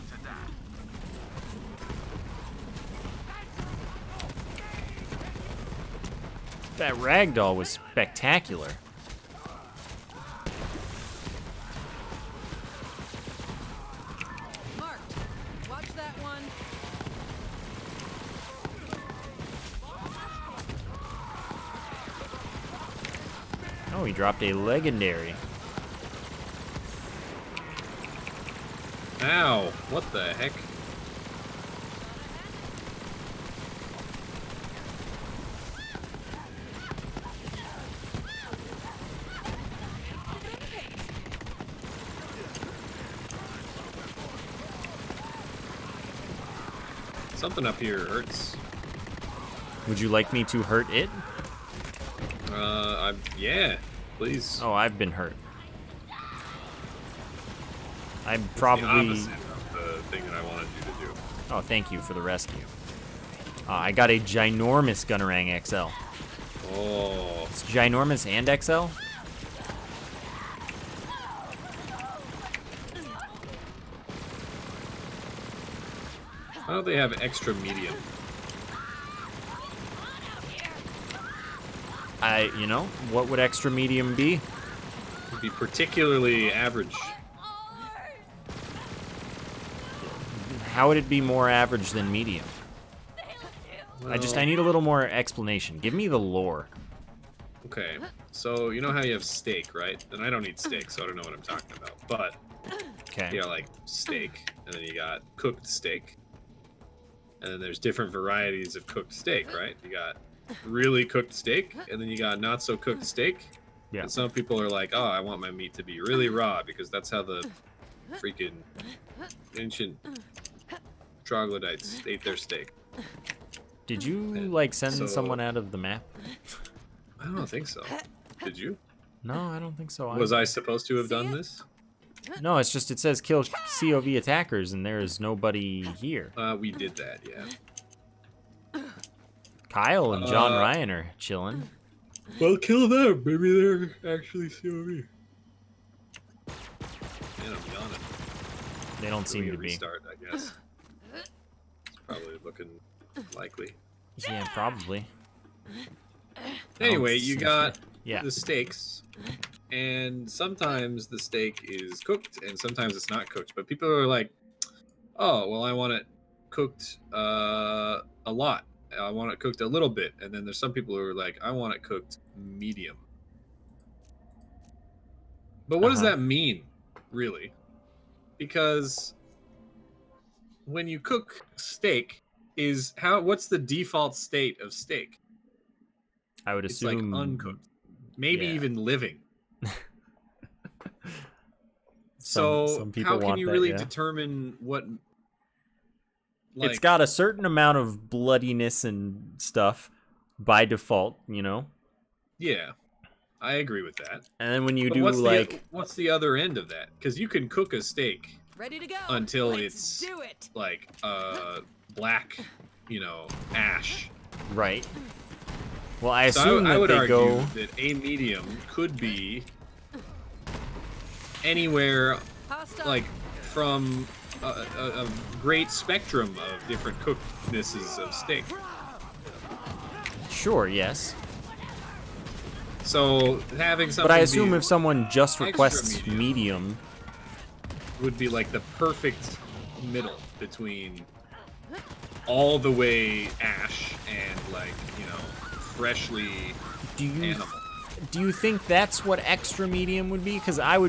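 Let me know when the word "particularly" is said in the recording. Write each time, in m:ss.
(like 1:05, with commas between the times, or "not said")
1:25.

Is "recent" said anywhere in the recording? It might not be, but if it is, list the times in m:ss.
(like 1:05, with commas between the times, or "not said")
not said.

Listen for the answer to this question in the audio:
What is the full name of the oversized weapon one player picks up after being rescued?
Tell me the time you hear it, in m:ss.
1:04.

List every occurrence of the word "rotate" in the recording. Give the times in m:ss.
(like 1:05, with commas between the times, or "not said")
not said.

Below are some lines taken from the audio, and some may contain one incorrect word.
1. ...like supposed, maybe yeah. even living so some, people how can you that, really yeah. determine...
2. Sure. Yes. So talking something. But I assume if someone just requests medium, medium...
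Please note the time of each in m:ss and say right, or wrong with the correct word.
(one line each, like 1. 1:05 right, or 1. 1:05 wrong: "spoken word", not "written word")
1. 3:07 wrong: "uncooked", not "supposed"
2. 3:50 wrong: "having", not "talking".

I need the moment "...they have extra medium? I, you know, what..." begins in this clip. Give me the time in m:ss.
1:16.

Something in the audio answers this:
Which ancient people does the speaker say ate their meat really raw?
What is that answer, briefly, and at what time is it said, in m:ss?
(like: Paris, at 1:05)
Ancient troglodytes, at 1:59.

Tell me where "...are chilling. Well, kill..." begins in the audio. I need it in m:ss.
2:20.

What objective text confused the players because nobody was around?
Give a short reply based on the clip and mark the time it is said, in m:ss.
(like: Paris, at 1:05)
Kill COV attackers, at 2:13.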